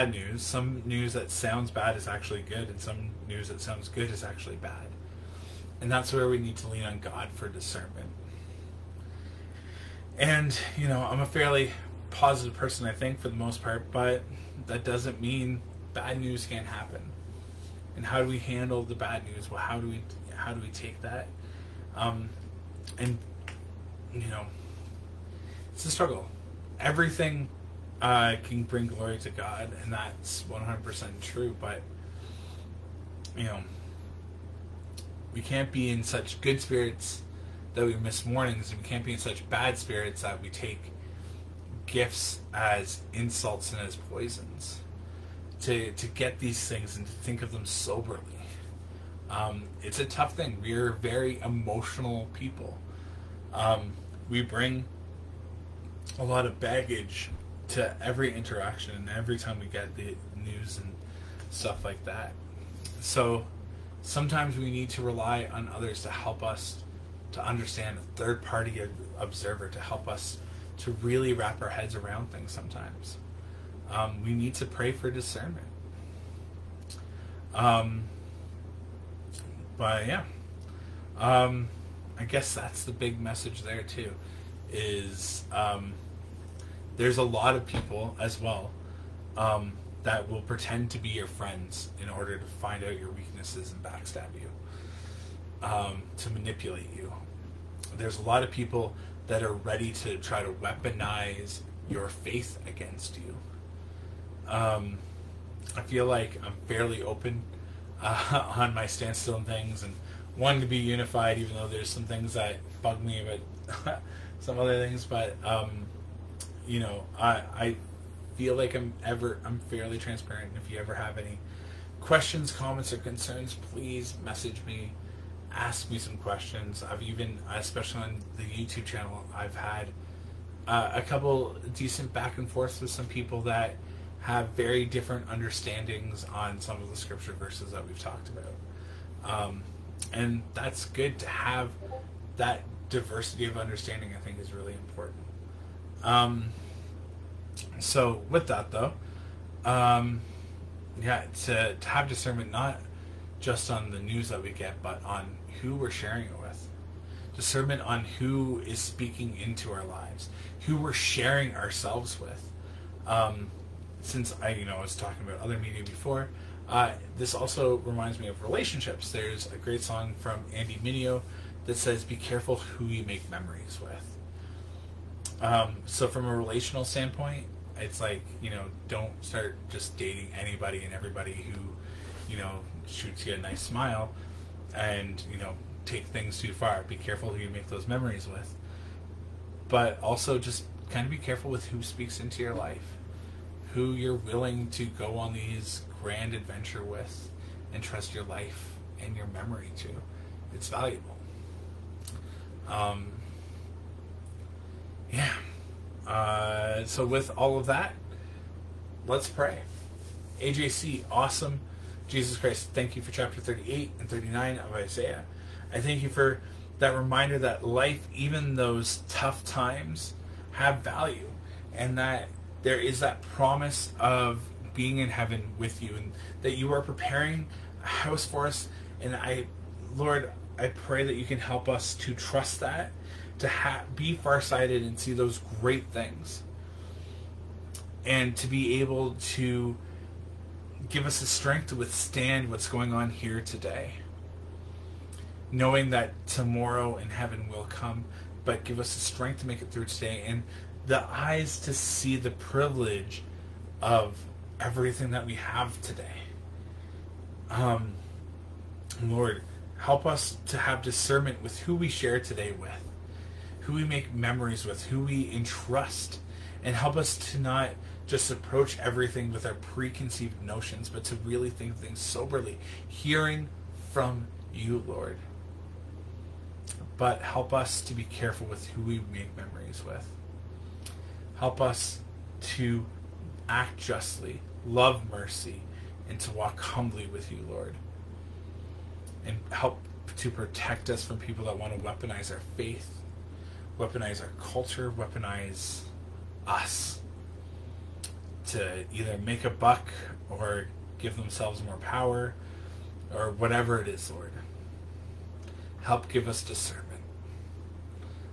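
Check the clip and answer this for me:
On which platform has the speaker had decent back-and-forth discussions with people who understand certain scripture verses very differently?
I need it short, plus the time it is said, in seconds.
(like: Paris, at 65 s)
YouTube, at 128 s.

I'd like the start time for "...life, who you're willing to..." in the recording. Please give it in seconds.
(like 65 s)
192 s.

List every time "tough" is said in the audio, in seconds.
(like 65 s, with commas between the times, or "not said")
50 s, 219 s.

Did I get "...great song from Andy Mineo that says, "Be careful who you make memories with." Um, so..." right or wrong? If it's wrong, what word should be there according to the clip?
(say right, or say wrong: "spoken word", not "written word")
right.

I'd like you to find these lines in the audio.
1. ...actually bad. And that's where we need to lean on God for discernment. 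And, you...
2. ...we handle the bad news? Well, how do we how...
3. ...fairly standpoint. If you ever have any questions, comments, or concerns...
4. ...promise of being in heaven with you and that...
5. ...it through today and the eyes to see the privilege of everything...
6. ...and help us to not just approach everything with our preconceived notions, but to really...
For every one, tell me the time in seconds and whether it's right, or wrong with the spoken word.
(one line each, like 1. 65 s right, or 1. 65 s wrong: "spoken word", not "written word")
1. 4 s right
2. 18 s right
3. 119 s wrong: "transparent", not "standpoint"
4. 223 s right
5. 249 s right
6. 266 s right.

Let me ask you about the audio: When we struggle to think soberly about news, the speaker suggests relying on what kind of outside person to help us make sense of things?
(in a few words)
third party observer.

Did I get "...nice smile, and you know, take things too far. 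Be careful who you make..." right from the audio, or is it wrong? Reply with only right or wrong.
right.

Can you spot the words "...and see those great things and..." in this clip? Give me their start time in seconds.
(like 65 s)
234 s.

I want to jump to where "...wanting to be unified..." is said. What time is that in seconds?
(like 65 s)
110 s.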